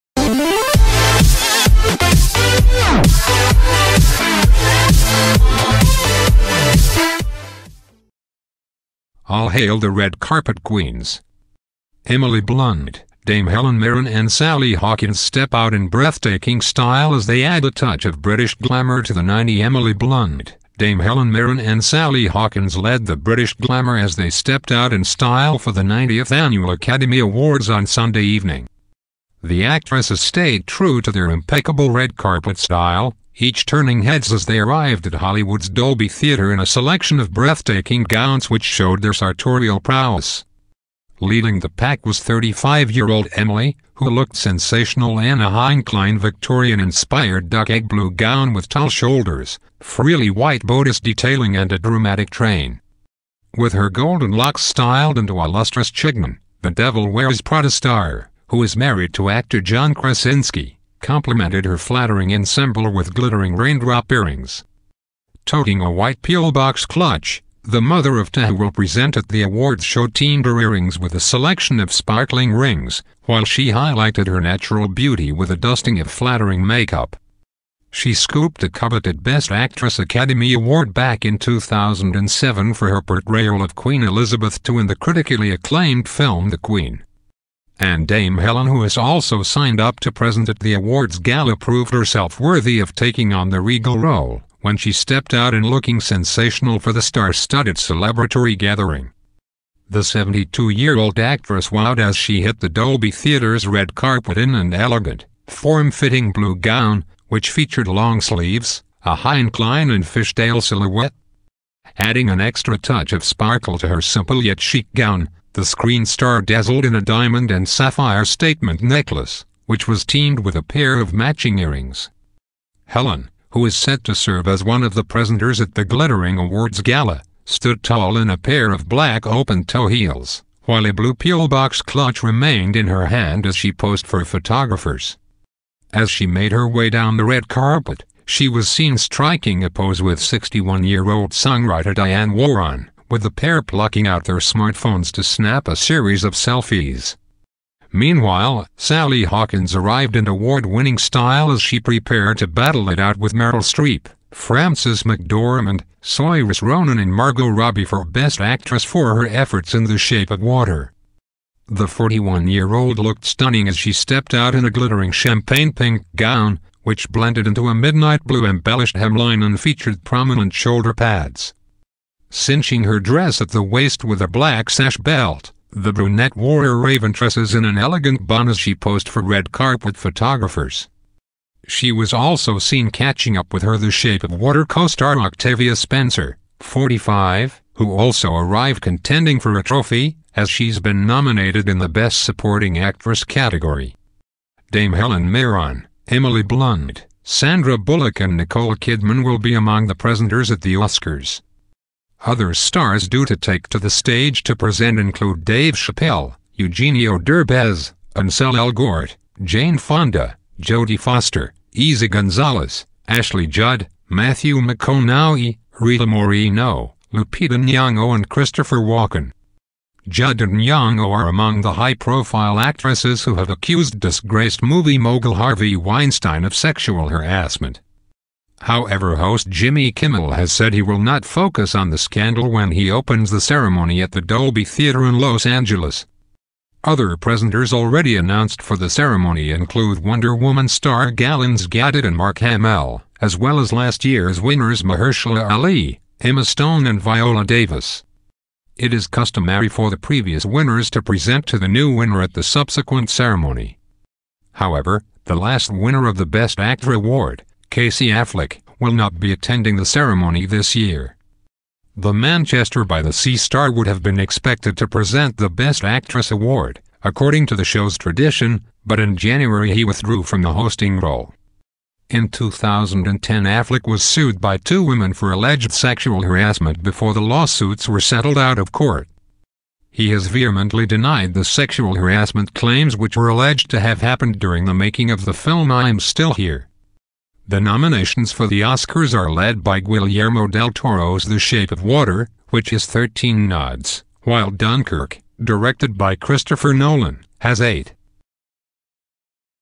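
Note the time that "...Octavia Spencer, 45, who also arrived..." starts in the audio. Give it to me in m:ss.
3:05.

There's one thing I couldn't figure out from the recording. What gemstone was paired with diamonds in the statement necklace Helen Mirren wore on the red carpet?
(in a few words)
Sapphire.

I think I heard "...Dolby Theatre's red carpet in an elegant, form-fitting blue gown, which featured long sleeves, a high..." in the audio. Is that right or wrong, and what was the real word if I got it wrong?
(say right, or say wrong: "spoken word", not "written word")
right.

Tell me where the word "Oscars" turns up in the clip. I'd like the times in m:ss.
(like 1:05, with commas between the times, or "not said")
3:20, 4:48.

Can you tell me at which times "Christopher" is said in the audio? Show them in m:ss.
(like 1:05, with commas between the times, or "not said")
3:38, 4:56.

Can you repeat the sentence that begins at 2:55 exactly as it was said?
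The brunette wore her raven tresses in an elegant bun as she posed for red carpet photographers.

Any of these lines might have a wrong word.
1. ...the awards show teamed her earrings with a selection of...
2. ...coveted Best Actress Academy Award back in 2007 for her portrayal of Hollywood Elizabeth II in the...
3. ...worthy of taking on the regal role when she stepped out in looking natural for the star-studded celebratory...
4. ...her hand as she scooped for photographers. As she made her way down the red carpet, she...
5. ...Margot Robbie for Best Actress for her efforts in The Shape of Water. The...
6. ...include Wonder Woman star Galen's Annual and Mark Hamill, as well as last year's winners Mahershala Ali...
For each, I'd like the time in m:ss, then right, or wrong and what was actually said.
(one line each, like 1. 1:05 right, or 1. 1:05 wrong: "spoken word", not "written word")
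1. 1:09 right
2. 1:18 wrong: "Queen", not "Hollywood"
3. 1:32 wrong: "sensational", not "natural"
4. 2:12 wrong: "posed", not "scooped"
5. 2:37 right
6. 3:59 wrong: "Gadot", not "Annual".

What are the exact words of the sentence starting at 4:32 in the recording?
In 2010 Affleck was sued by two women for alleged sexual harassment before the lawsuits were settled out of court.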